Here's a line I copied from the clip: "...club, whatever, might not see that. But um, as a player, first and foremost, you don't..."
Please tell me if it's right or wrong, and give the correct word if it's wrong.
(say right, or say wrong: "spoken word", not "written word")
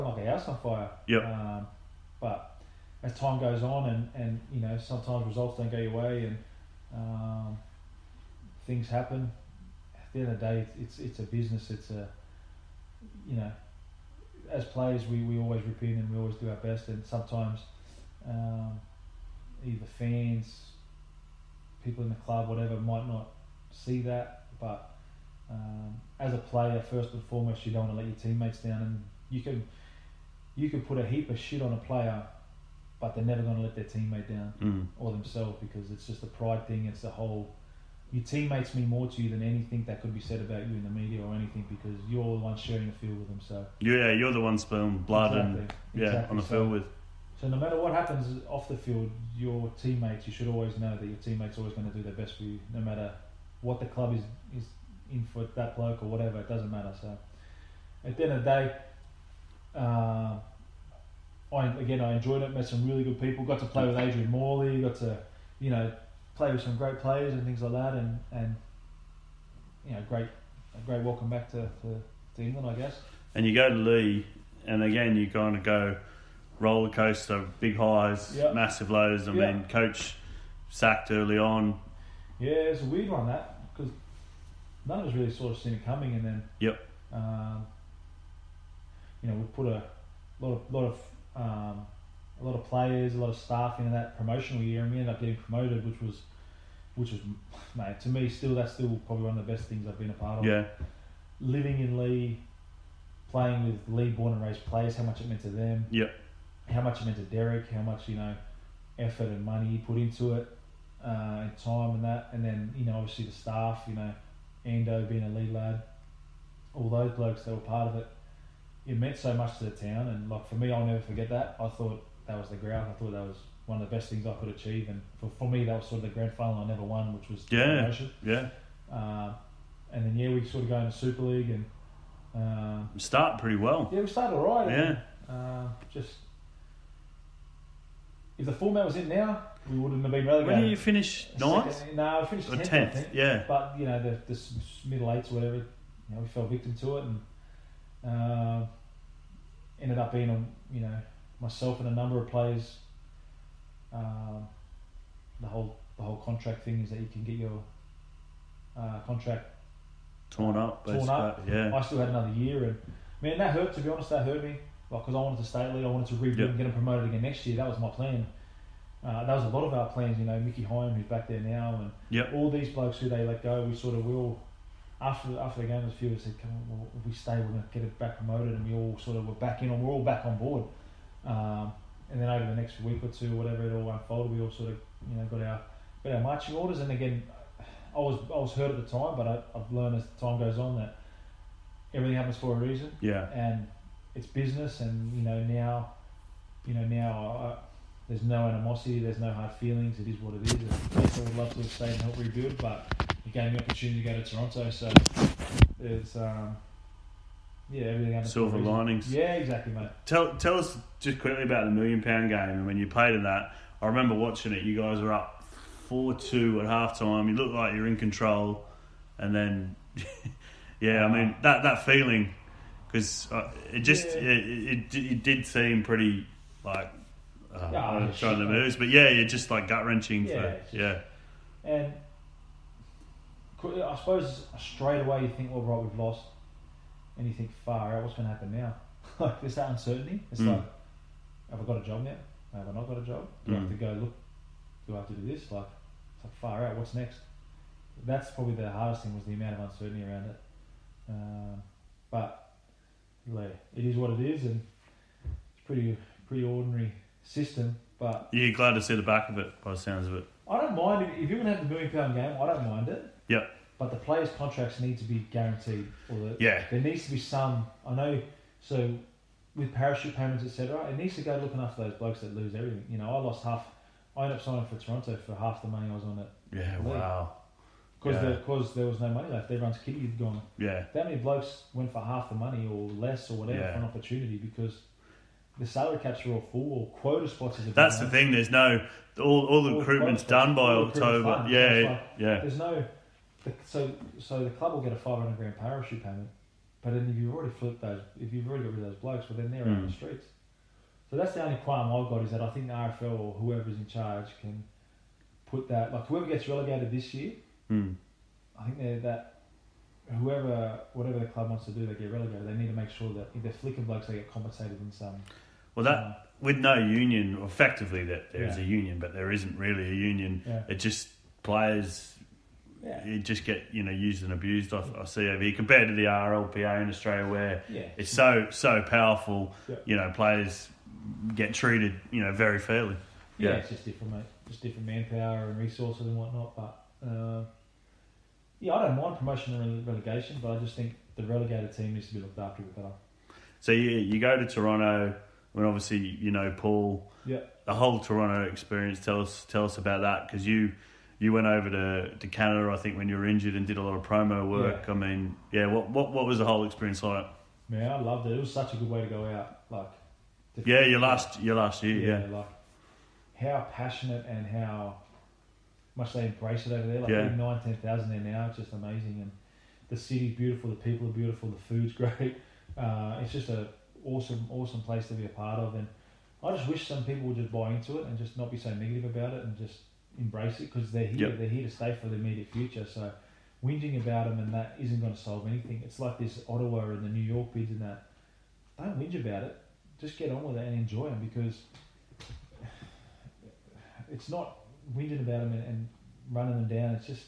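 right.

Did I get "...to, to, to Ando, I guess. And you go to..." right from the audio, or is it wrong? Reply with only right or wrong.
wrong.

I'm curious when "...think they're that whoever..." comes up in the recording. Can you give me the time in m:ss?
5:08.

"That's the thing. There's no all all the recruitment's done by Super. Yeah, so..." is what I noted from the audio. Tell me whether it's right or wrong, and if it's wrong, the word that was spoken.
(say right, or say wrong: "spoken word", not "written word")
wrong: "October", not "Super".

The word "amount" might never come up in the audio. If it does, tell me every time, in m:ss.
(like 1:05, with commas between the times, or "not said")
4:09.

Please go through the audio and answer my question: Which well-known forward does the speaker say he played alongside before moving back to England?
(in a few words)
Adrian Morley.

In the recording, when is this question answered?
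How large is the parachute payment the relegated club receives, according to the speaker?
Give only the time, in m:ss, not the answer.
4:54.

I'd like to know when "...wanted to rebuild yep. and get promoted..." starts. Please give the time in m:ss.
2:45.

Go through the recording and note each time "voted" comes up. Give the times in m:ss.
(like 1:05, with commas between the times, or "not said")
not said.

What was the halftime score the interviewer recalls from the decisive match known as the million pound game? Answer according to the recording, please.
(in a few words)
4-2.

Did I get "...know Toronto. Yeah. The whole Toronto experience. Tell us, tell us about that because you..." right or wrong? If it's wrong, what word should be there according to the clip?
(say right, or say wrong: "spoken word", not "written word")
wrong: "Paul", not "Toronto".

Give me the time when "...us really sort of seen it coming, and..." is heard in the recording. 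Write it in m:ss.
1:25.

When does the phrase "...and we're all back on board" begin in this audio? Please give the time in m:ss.
2:59.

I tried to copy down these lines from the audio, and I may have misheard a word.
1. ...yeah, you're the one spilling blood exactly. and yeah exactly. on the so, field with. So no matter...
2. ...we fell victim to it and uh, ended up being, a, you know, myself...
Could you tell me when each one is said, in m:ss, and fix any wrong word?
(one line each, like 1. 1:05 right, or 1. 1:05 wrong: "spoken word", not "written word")
1. 0:43 right
2. 2:26 right.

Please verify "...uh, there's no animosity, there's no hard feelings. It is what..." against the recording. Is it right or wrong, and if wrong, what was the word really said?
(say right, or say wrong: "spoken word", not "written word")
right.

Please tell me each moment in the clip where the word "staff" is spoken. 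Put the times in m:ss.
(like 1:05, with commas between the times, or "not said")
1:33, 1:53.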